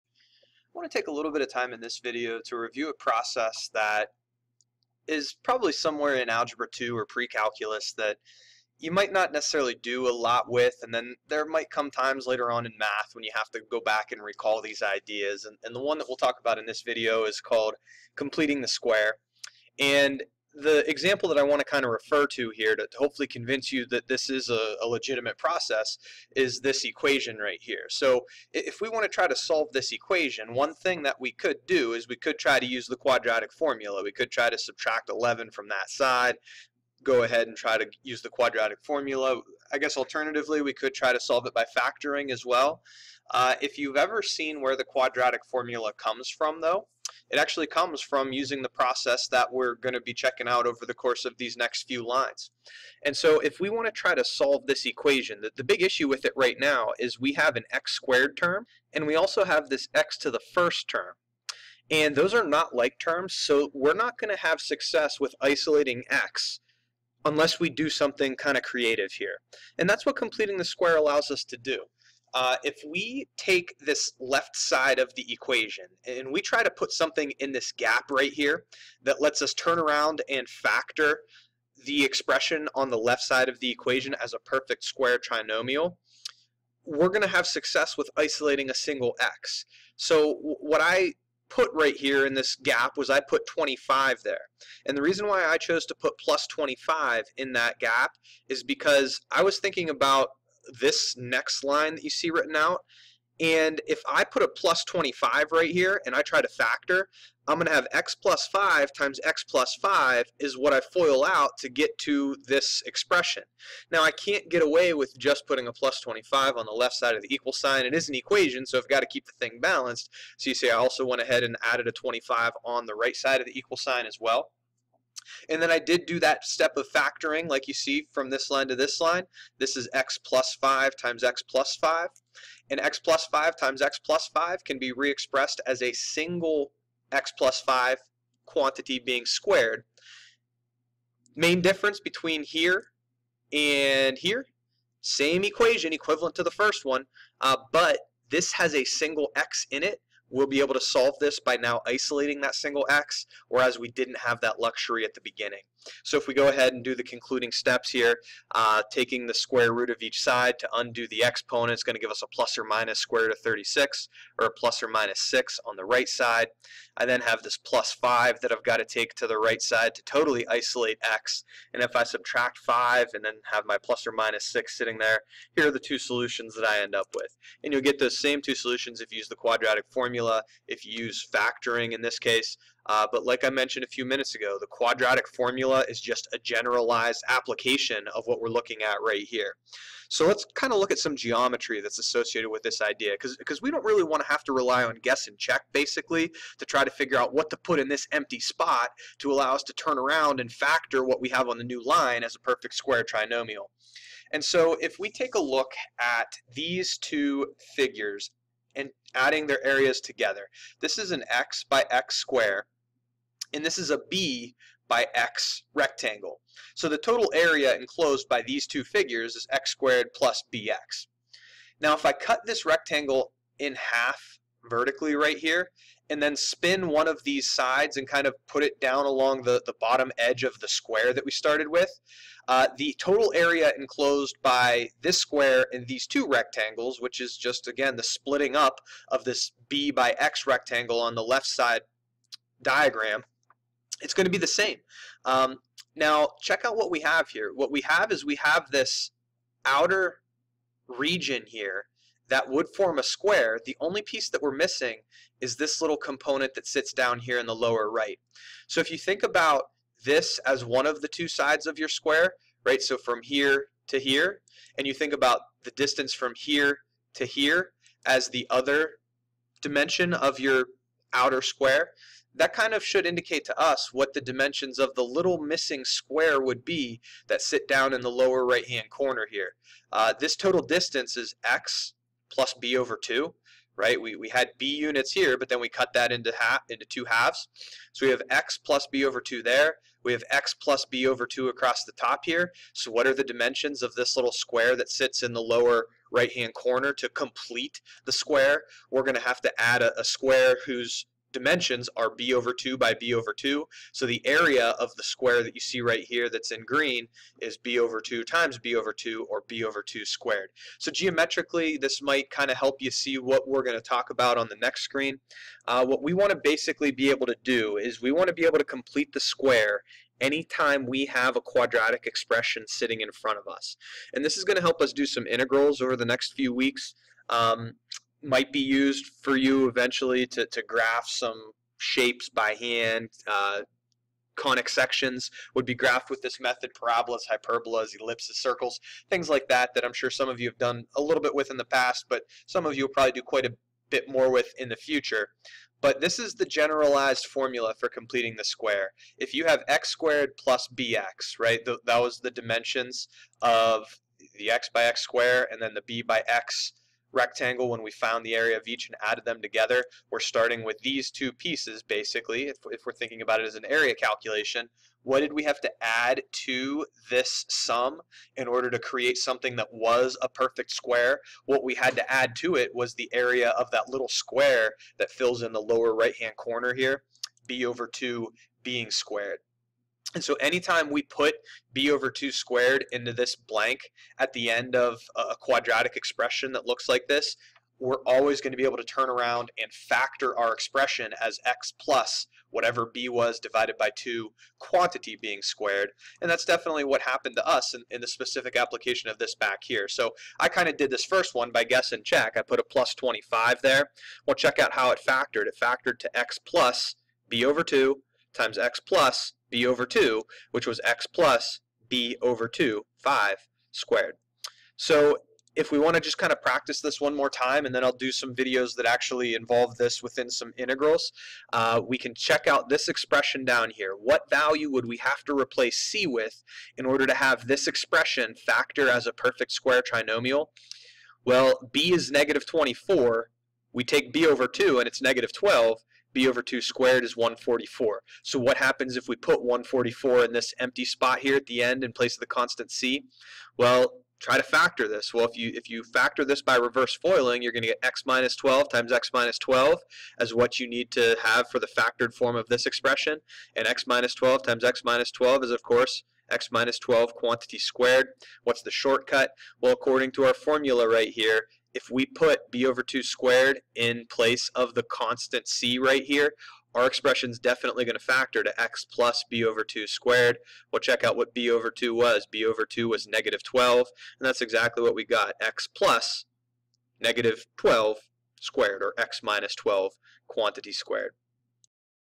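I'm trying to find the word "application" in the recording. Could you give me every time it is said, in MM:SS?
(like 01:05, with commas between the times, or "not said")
03:07, 06:38.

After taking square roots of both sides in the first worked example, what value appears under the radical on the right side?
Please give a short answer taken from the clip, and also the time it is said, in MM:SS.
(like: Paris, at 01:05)
36, at 02:42.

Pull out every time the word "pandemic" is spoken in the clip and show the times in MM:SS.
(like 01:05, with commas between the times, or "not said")
not said.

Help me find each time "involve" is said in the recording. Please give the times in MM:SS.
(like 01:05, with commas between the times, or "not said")
06:59.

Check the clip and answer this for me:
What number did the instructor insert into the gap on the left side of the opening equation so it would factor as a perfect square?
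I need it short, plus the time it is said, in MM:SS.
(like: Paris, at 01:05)
25, at 01:33.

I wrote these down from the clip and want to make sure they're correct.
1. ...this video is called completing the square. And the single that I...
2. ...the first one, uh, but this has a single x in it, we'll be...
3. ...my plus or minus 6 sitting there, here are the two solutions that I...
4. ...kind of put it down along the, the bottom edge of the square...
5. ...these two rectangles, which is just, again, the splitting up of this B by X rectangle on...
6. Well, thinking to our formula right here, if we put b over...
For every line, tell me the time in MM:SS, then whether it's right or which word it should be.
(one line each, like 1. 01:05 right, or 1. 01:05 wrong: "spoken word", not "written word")
1. 00:16 wrong: "example", not "single"
2. 02:26 right
3. 02:53 right
4. 03:48 right
5. 03:55 right
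6. 07:39 wrong: "according", not "thinking".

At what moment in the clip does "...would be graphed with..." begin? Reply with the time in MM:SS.
05:35.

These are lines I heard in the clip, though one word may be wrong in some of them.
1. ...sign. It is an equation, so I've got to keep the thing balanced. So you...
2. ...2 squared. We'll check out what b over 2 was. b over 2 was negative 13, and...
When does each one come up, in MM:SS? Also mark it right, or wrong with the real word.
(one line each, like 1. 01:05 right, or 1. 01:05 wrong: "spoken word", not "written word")
1. 01:57 right
2. 07:49 wrong: "12", not "13".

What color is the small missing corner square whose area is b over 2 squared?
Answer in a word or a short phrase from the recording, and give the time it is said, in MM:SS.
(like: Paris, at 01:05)
Green, at 05:06.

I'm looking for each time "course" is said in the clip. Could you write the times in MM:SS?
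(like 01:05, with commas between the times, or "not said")
00:50, 07:35.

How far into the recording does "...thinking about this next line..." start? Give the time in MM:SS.
01:39.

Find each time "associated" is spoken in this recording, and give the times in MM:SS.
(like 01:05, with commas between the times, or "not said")
03:11.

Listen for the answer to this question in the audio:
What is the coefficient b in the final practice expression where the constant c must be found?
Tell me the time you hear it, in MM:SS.
07:12.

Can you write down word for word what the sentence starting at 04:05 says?
Um, now, check out what we have here.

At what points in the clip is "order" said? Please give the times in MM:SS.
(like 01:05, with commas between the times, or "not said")
06:08, 07:06.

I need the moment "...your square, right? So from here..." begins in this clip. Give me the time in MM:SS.
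04:21.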